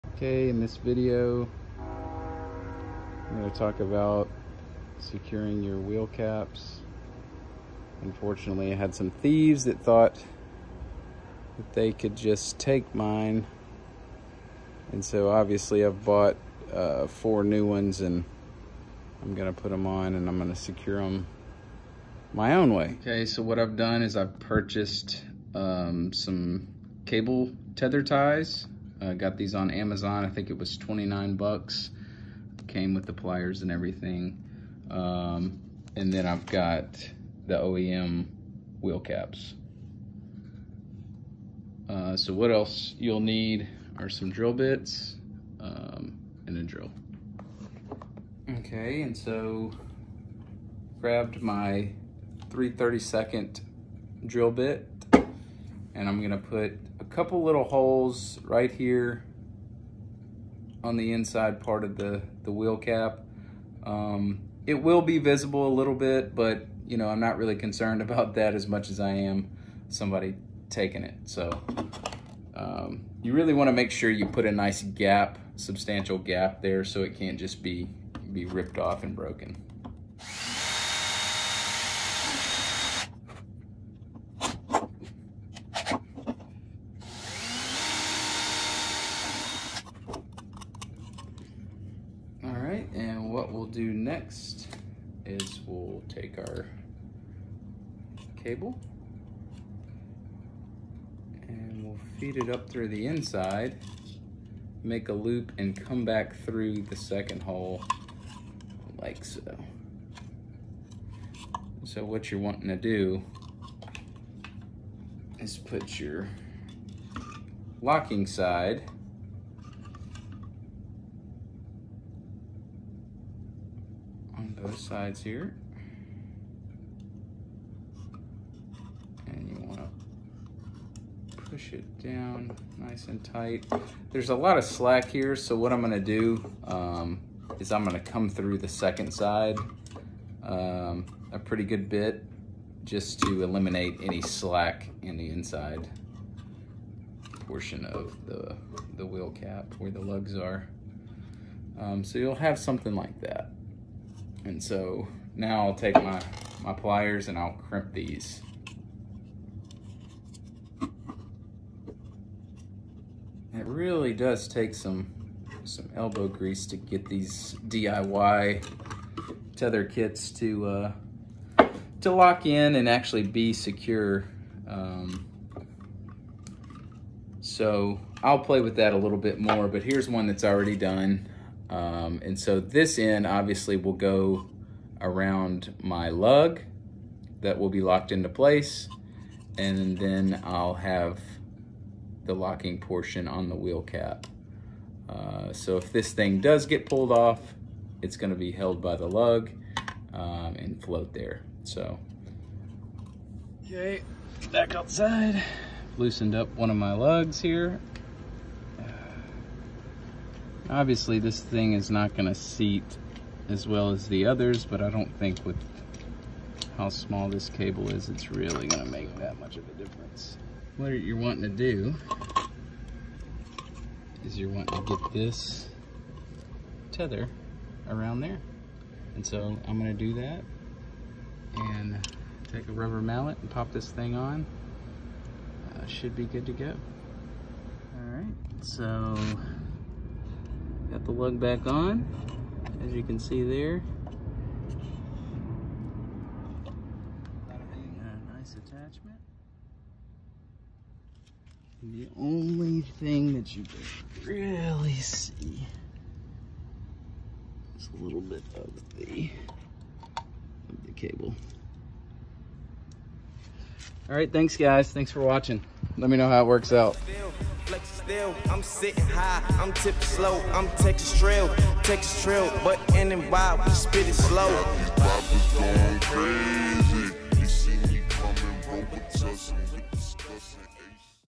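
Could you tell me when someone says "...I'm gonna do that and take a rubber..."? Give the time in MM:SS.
03:49.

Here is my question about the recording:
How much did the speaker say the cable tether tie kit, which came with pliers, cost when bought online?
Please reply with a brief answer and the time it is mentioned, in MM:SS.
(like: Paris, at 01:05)
29 bucks, at 00:30.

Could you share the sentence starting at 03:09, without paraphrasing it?
And then I'll have the locking portion on the wheel cap.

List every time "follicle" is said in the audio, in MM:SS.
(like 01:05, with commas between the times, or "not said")
not said.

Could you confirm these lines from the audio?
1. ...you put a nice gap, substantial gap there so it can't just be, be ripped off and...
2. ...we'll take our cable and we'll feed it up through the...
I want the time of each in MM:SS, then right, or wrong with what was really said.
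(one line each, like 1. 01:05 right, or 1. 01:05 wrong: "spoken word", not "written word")
1. 01:14 right
2. 01:35 right.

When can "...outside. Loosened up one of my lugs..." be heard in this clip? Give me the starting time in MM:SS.
03:24.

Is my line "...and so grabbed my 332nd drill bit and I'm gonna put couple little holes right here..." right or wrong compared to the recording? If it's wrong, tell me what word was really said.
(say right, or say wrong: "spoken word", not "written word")
right.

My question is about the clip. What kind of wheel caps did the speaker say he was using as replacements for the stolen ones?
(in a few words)
OEM wheel caps.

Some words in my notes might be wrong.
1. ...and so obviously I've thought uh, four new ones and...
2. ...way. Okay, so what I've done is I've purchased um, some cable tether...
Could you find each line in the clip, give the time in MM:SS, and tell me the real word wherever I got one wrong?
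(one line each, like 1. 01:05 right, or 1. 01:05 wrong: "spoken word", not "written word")
1. 00:14 wrong: "bought", not "thought"
2. 00:22 right.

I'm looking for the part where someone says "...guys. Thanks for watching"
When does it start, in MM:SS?
04:24.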